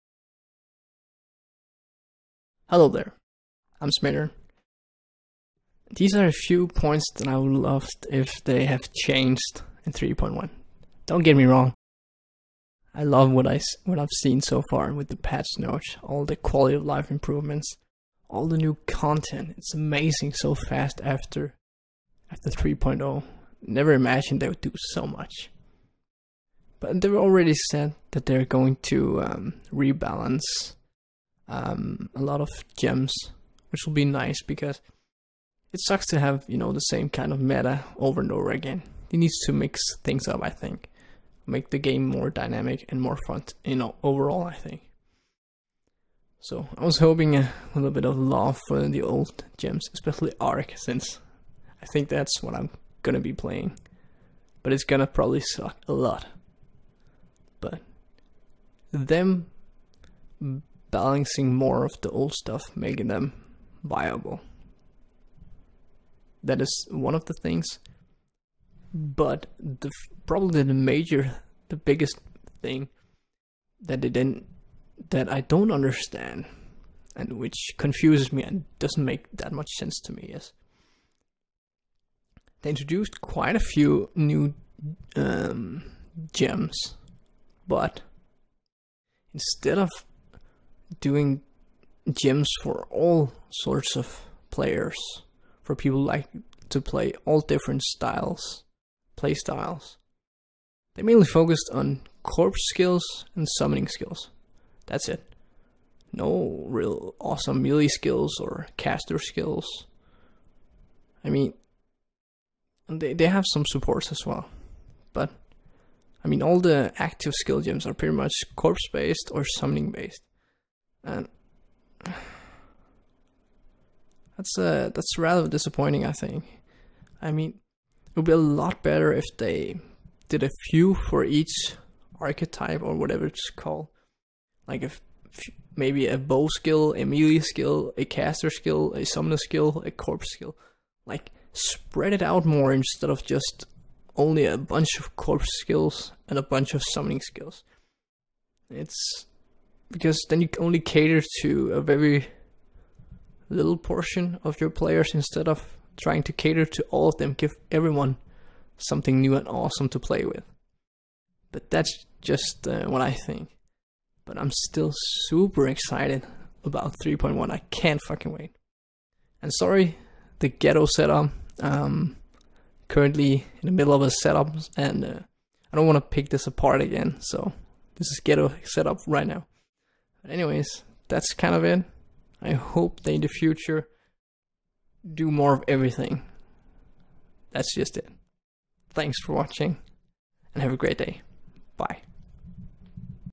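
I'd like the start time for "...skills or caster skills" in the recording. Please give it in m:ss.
1:47.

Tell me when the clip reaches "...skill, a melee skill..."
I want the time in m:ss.
2:16.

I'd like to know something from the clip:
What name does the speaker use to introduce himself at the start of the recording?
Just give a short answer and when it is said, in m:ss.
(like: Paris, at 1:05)
Schmidter, at 0:03.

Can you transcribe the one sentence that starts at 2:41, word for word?
But that's just uh, what I think.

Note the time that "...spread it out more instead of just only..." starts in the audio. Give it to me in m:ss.
2:21.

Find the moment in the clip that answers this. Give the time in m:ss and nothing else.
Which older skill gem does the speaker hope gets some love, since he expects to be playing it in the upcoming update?
0:50.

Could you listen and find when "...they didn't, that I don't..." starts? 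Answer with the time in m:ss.
1:14.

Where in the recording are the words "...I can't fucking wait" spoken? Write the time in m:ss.
2:47.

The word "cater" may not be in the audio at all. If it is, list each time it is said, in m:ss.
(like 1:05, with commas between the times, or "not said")
2:30, 2:36.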